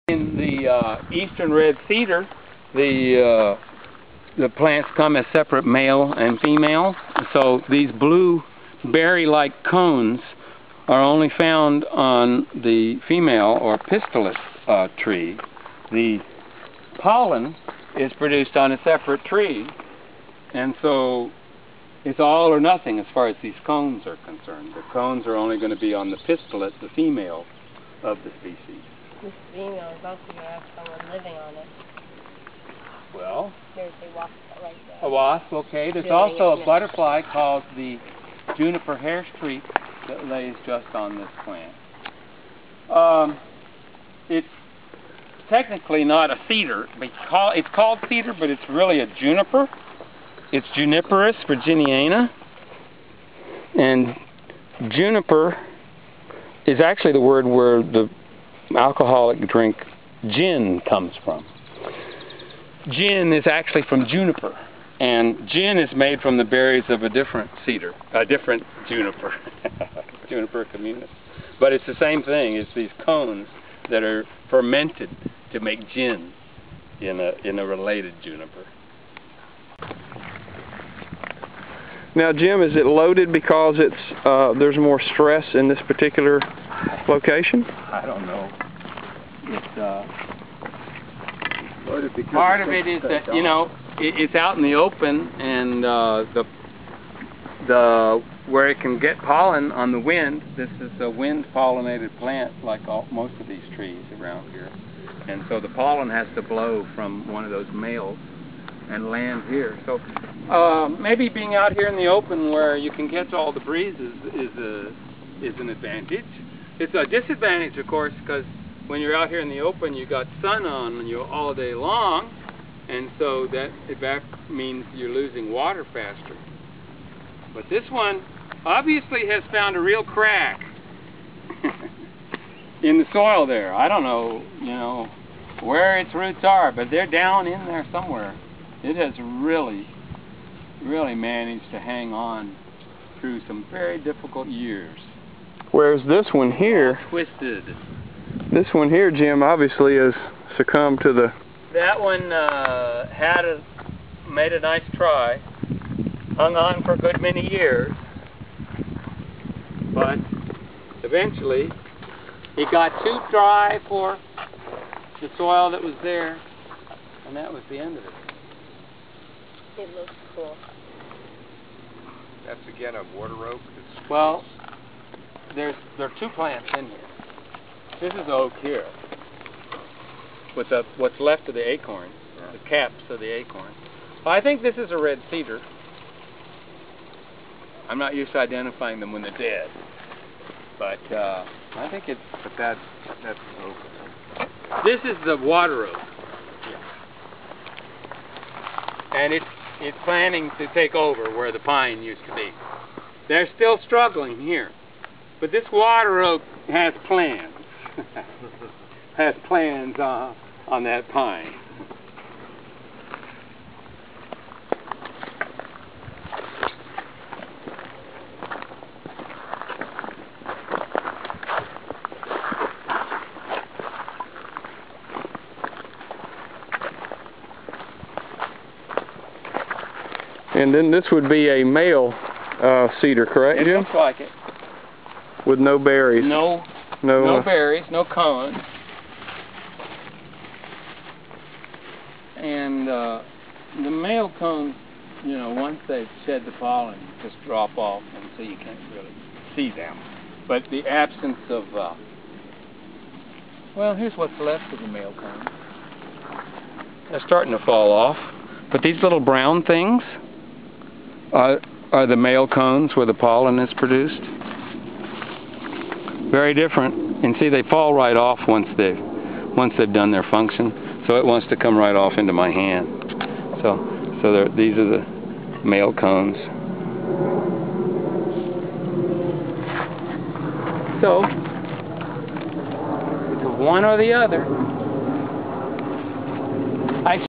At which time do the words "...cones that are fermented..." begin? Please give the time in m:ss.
1:13.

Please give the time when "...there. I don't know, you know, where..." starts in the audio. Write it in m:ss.
2:13.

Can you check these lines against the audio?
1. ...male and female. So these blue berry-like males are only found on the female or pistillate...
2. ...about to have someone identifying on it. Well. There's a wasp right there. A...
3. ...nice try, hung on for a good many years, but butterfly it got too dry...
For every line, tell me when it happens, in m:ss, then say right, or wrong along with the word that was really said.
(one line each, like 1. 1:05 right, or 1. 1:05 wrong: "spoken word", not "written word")
1. 0:05 wrong: "cones", not "males"
2. 0:29 wrong: "living", not "identifying"
3. 2:34 wrong: "eventually", not "butterfly".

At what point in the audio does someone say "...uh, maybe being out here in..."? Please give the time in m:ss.
1:50.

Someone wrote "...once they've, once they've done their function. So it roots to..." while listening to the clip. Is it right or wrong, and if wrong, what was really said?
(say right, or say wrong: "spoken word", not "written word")
wrong: "wants", not "roots".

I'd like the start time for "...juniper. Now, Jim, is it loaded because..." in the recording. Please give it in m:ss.
1:18.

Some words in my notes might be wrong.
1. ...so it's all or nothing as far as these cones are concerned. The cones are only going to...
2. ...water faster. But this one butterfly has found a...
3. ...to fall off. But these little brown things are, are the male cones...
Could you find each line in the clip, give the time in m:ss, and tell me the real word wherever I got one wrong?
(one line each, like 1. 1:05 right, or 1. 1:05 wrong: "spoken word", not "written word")
1. 0:20 right
2. 2:05 wrong: "obviously", not "butterfly"
3. 4:17 right.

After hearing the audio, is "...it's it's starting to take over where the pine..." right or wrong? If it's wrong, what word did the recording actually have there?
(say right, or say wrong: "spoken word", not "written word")
wrong: "planning", not "starting".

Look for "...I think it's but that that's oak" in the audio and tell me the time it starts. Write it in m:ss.
3:11.